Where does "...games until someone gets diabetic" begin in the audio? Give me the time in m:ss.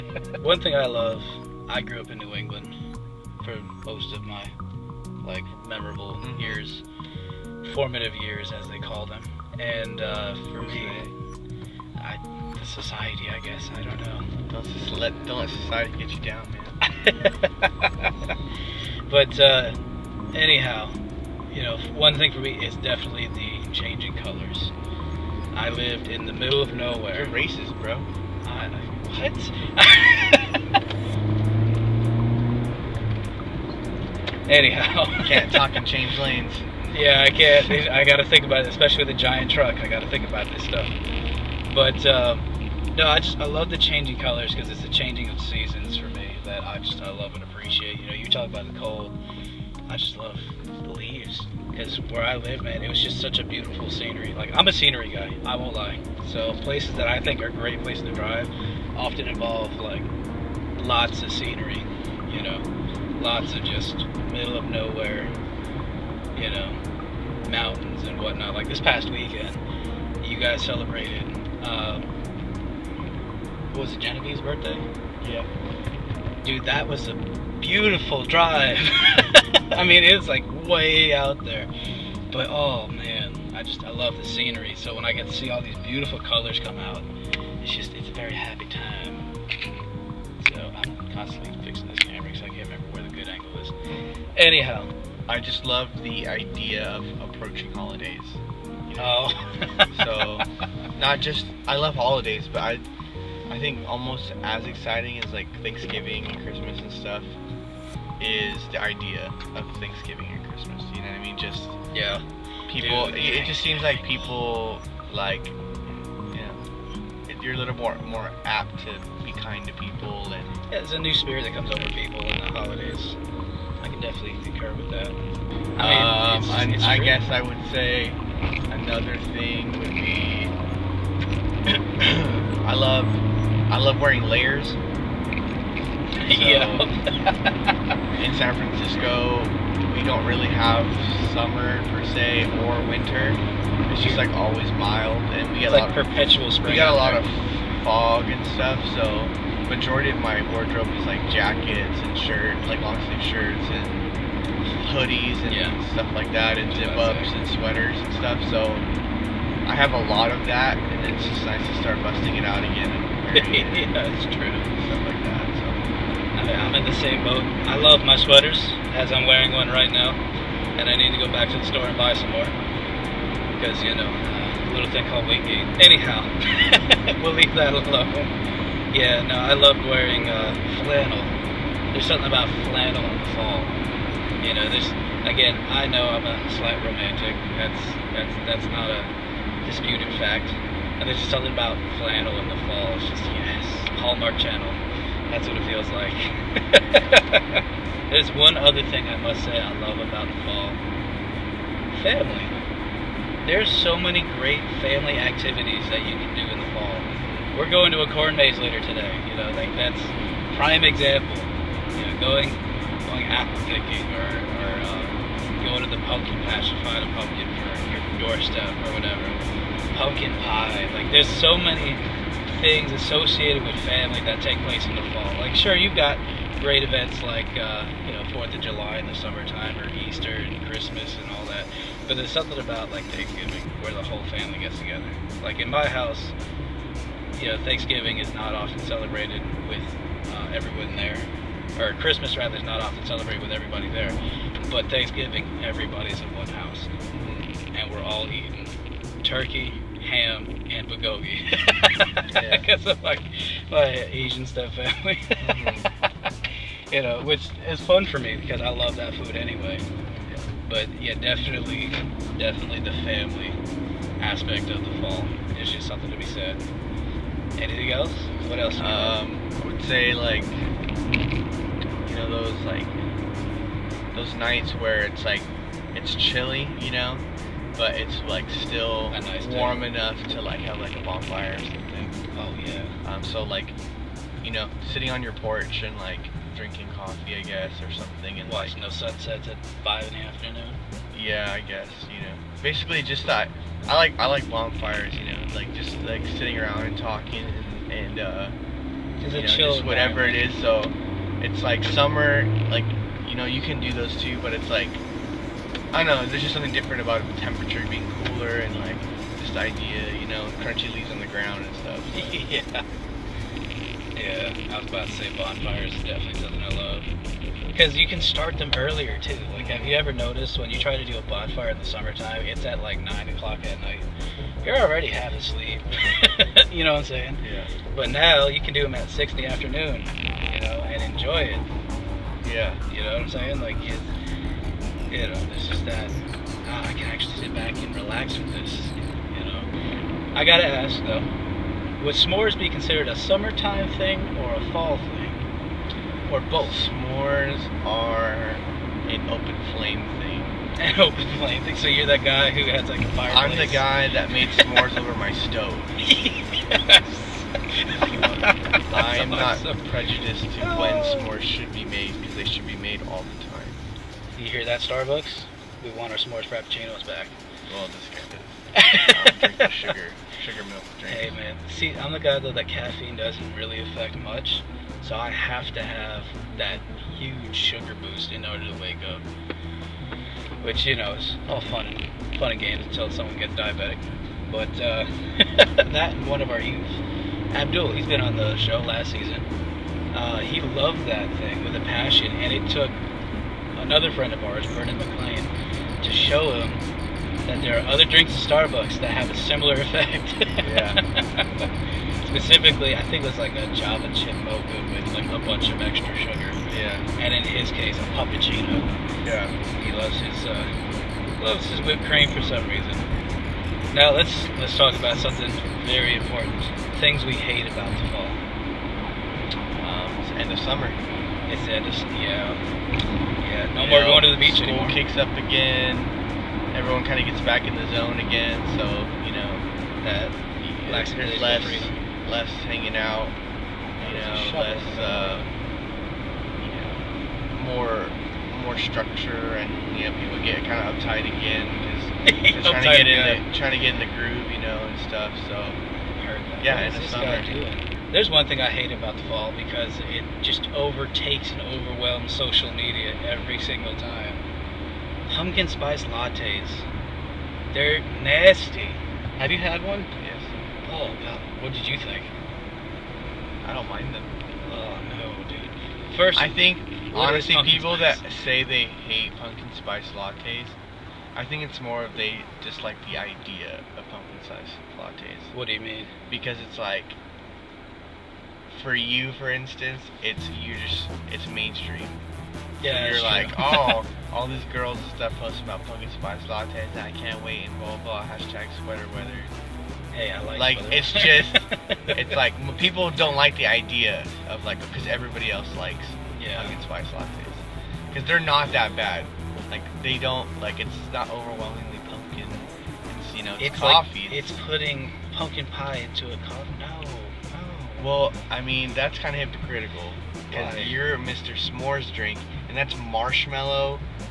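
6:22.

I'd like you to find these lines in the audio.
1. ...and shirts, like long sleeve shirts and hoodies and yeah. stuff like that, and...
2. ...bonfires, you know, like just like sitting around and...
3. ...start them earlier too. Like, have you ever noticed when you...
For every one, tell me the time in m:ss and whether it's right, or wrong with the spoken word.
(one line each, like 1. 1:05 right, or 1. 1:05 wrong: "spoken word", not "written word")
1. 2:31 right
2. 4:54 right
3. 5:18 right.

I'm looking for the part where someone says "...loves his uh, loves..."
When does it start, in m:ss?
6:49.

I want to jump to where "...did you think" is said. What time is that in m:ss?
7:41.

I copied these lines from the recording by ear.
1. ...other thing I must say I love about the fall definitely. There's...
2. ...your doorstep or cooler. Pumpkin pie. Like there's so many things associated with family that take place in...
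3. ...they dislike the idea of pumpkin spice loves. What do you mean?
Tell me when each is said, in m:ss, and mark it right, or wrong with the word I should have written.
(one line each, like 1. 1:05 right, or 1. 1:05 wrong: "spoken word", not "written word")
1. 3:18 wrong: "family", not "definitely"
2. 3:37 wrong: "whatever", not "cooler"
3. 7:52 wrong: "lattes", not "loves".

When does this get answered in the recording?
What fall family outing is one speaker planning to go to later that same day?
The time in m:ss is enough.
3:28.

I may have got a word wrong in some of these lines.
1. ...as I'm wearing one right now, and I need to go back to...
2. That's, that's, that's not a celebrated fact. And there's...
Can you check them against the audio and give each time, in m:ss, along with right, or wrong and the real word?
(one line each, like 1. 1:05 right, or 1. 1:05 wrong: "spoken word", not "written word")
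1. 2:48 right
2. 3:07 wrong: "disputed", not "celebrated".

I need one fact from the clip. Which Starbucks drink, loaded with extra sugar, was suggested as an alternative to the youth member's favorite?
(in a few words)
Java chip mocha.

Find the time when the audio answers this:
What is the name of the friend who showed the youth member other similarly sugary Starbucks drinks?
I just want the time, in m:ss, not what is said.
6:34.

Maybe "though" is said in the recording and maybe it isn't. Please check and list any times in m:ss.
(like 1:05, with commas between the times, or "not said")
5:41, 6:12.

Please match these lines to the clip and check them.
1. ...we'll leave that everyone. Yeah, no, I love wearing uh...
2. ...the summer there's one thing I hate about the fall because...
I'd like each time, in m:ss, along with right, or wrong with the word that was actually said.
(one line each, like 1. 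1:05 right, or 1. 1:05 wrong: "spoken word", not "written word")
1. 2:57 wrong: "alone", not "everyone"
2. 7:26 right.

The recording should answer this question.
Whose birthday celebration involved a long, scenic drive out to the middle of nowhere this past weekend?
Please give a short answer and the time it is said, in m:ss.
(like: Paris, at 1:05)
Genevieve, at 1:13.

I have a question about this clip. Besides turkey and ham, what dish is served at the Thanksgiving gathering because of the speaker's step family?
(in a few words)
Bulgogi.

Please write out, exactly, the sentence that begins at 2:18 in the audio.
in San Francisco, we don't really have summer per se or winter.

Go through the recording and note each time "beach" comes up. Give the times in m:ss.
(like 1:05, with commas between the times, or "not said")
7:04.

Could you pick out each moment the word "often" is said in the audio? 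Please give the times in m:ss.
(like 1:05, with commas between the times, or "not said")
0:58, 3:58, 4:02.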